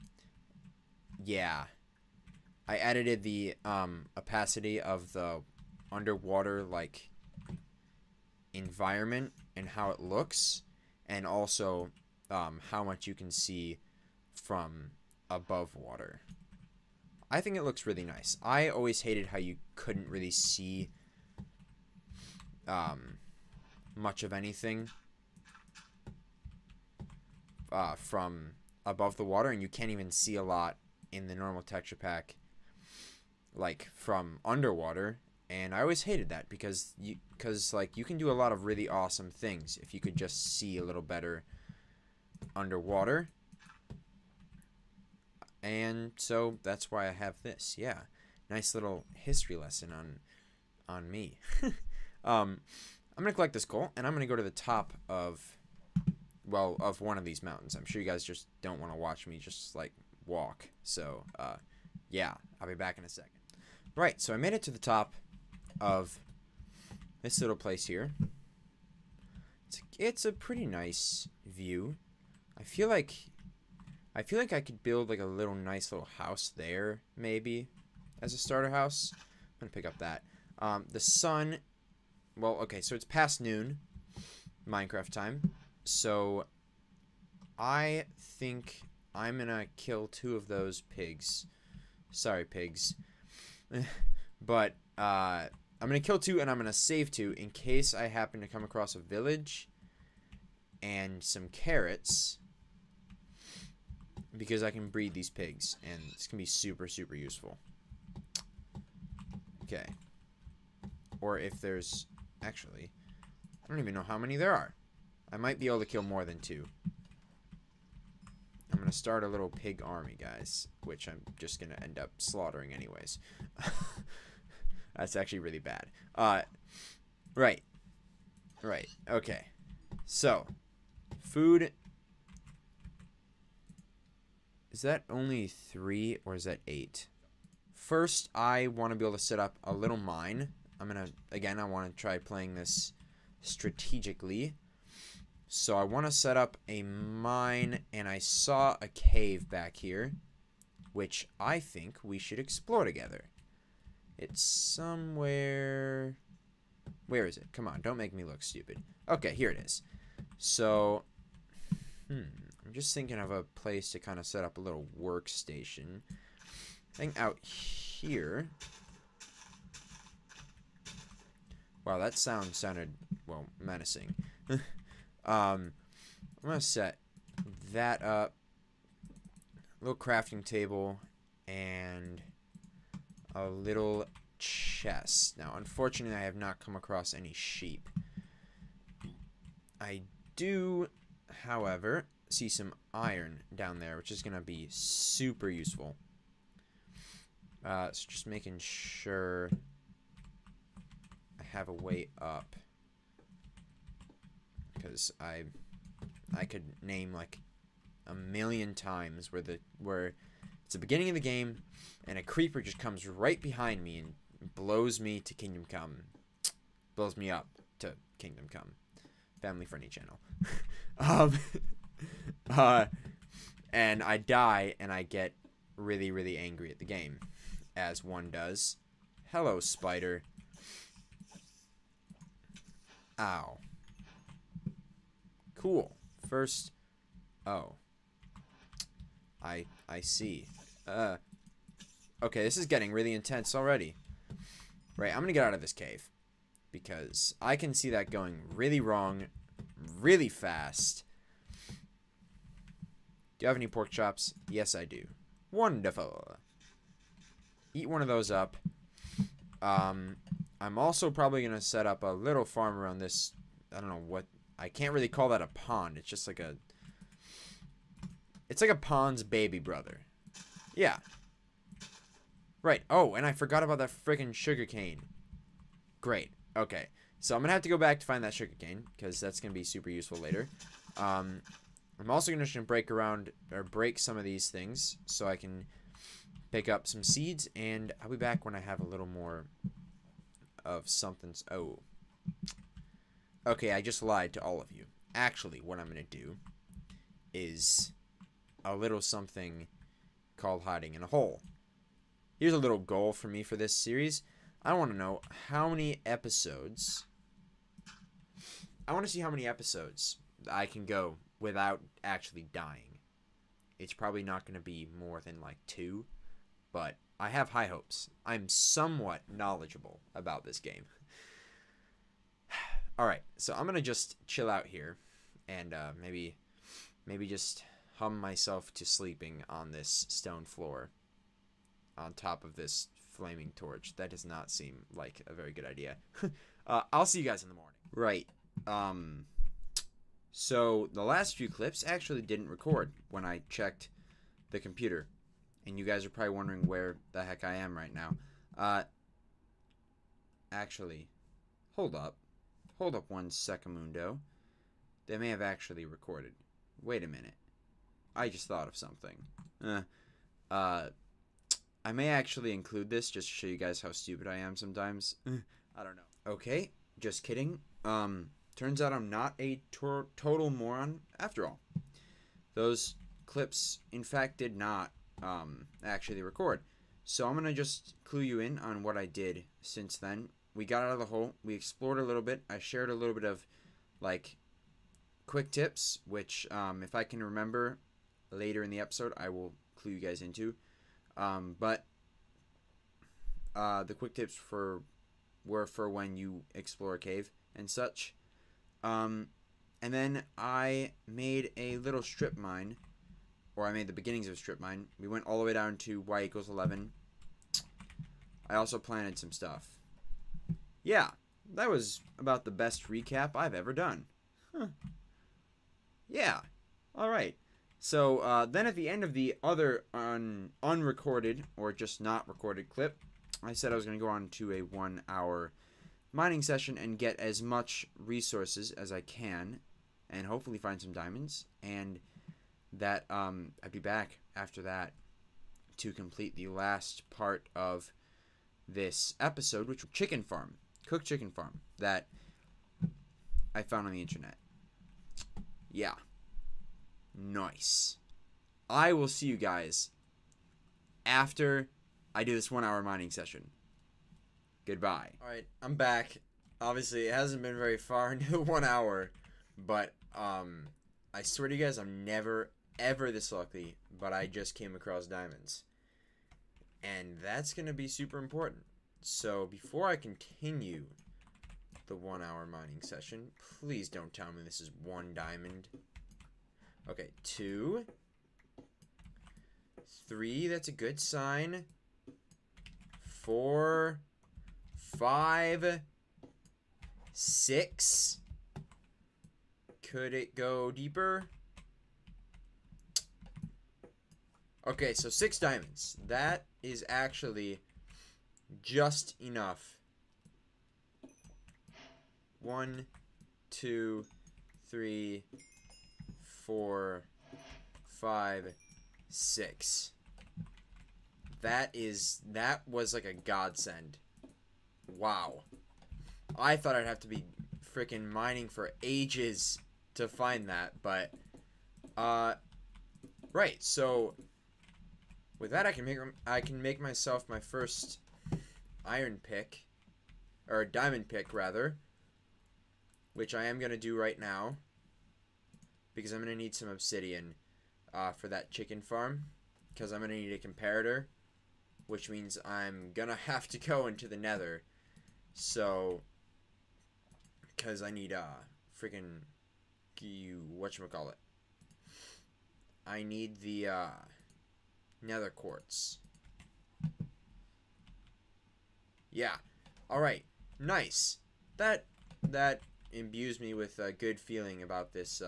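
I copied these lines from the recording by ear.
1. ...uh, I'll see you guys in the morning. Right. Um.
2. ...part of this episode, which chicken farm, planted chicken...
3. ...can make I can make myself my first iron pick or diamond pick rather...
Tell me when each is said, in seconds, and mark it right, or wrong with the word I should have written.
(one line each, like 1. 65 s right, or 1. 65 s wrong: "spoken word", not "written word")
1. 336 s right
2. 437 s wrong: "cooked", not "planted"
3. 525 s right.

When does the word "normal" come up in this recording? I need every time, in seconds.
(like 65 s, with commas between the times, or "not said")
31 s.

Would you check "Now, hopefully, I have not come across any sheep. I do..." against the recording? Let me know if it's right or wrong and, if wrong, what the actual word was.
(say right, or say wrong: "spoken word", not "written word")
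wrong: "unfortunately", not "hopefully".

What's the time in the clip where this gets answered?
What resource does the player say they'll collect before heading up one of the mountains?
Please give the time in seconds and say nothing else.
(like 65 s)
53 s.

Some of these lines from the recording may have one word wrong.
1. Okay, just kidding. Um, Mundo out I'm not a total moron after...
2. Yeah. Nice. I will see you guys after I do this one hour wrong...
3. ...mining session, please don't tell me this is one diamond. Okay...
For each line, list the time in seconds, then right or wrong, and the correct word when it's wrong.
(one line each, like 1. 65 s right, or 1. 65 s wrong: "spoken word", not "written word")
1. 366 s wrong: "Turns", not "Mundo"
2. 445 s wrong: "mining", not "wrong"
3. 472 s right.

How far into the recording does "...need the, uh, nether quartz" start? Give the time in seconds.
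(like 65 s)
553 s.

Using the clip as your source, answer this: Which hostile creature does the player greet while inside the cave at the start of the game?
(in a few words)
Spider.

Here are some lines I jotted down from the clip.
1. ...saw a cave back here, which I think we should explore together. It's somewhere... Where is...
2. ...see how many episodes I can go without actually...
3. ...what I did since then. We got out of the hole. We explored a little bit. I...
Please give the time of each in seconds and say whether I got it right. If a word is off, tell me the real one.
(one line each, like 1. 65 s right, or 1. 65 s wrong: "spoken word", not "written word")
1. 148 s right
2. 309 s right
3. 378 s right.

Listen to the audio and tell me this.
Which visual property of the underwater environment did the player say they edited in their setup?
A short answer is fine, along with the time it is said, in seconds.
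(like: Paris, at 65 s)
Opacity, at 4 s.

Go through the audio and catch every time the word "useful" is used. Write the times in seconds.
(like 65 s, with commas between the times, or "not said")
107 s, 195 s, 279 s.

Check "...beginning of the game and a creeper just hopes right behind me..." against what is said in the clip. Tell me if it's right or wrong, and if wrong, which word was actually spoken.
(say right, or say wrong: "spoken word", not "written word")
wrong: "comes", not "hopes".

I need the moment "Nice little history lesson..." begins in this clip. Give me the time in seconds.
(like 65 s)
48 s.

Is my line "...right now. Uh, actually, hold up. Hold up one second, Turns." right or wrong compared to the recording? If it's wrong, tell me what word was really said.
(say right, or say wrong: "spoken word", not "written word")
wrong: "Mundo", not "Turns".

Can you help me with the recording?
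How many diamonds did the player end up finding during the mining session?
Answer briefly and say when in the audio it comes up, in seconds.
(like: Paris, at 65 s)
6, at 495 s.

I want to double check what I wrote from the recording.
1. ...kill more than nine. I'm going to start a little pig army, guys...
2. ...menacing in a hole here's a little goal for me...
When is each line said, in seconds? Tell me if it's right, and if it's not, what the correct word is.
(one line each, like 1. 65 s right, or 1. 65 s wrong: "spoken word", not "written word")
1. 115 s wrong: "two", not "nine"
2. 300 s wrong: "hiding", not "menacing".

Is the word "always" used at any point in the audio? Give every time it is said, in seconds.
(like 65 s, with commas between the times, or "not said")
18 s, 35 s.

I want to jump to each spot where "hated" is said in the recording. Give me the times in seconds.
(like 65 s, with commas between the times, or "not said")
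19 s, 36 s.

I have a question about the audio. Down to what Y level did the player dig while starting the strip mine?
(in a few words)
11.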